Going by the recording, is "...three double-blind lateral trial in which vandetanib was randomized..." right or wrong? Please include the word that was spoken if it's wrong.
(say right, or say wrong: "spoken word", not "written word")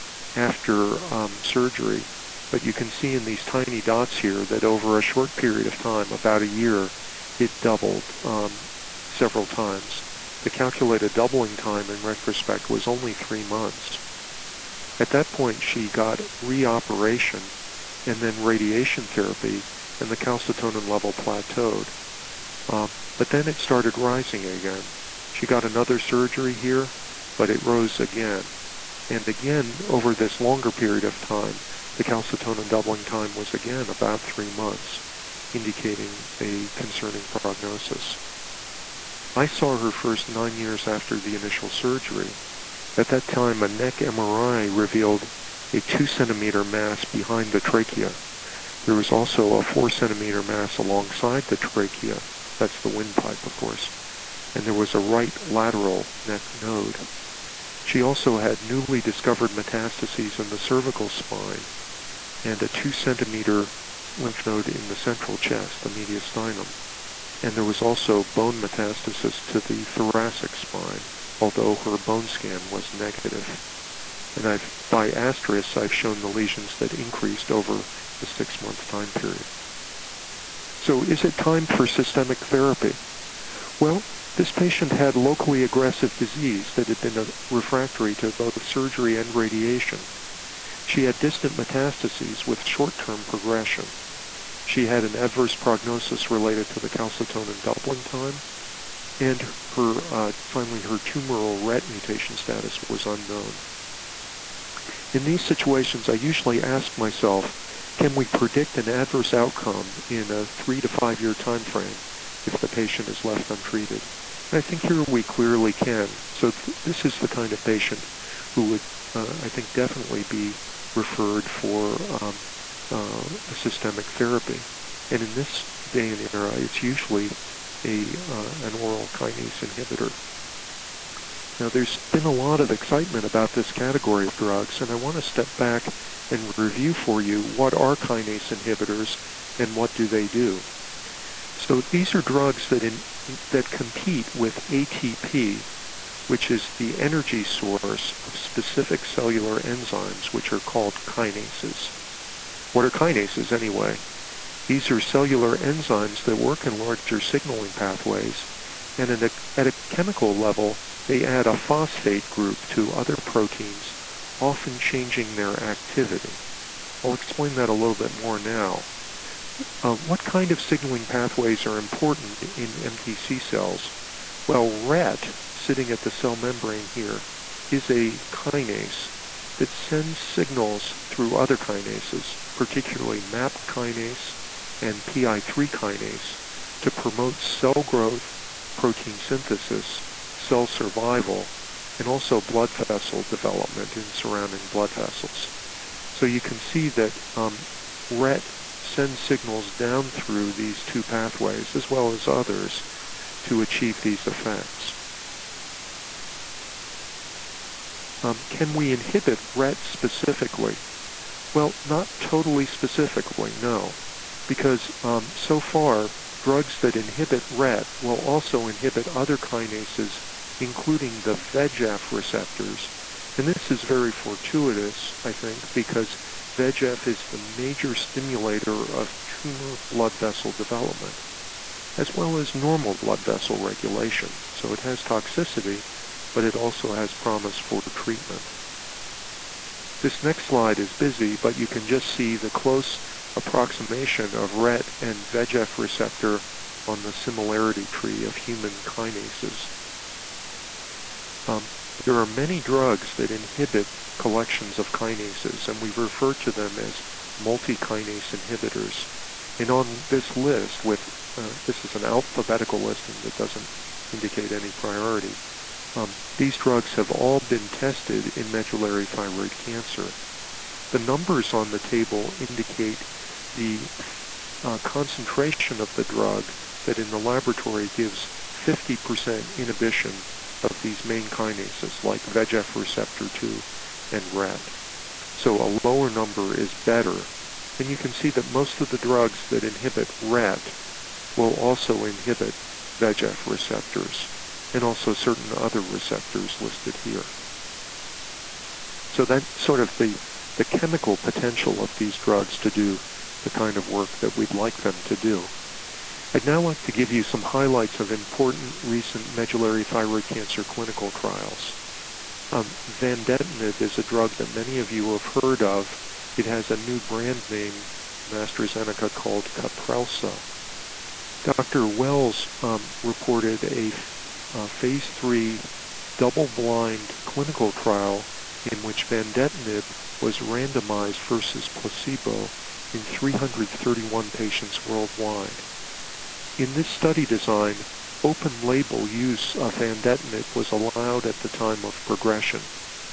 wrong: "clinical", not "lateral".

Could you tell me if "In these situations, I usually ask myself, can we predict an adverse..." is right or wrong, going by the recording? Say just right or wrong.
right.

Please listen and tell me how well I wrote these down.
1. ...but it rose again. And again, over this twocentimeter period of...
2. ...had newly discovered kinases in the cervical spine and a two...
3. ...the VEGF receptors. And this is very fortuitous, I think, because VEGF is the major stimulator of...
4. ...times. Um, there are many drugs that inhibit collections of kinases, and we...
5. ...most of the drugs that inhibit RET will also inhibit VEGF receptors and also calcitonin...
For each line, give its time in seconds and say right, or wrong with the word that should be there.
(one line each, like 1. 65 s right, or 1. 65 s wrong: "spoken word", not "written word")
1. 27 s wrong: "longer", not "twocentimeter"
2. 58 s wrong: "metastases", not "kinases"
3. 221 s right
4. 248 s wrong: "kinases", not "times"
5. 288 s wrong: "certain", not "calcitonin".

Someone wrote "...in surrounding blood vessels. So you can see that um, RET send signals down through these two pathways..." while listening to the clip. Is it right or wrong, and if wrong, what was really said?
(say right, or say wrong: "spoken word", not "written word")
right.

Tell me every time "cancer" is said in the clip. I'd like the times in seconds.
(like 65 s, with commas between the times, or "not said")
269 s, 310 s.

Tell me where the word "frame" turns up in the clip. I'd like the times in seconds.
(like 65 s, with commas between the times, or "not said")
111 s.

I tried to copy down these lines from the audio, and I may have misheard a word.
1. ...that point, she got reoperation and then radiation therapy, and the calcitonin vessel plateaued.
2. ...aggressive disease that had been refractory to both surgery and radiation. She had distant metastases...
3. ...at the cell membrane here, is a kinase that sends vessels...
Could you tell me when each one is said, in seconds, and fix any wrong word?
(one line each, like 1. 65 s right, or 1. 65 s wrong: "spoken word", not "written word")
1. 15 s wrong: "level", not "vessel"
2. 85 s right
3. 175 s wrong: "signals", not "vessels".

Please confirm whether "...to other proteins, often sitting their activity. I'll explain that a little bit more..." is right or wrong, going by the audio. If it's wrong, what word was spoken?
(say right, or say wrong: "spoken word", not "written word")
wrong: "changing", not "sitting".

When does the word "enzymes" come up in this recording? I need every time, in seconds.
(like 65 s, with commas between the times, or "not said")
149 s, 155 s.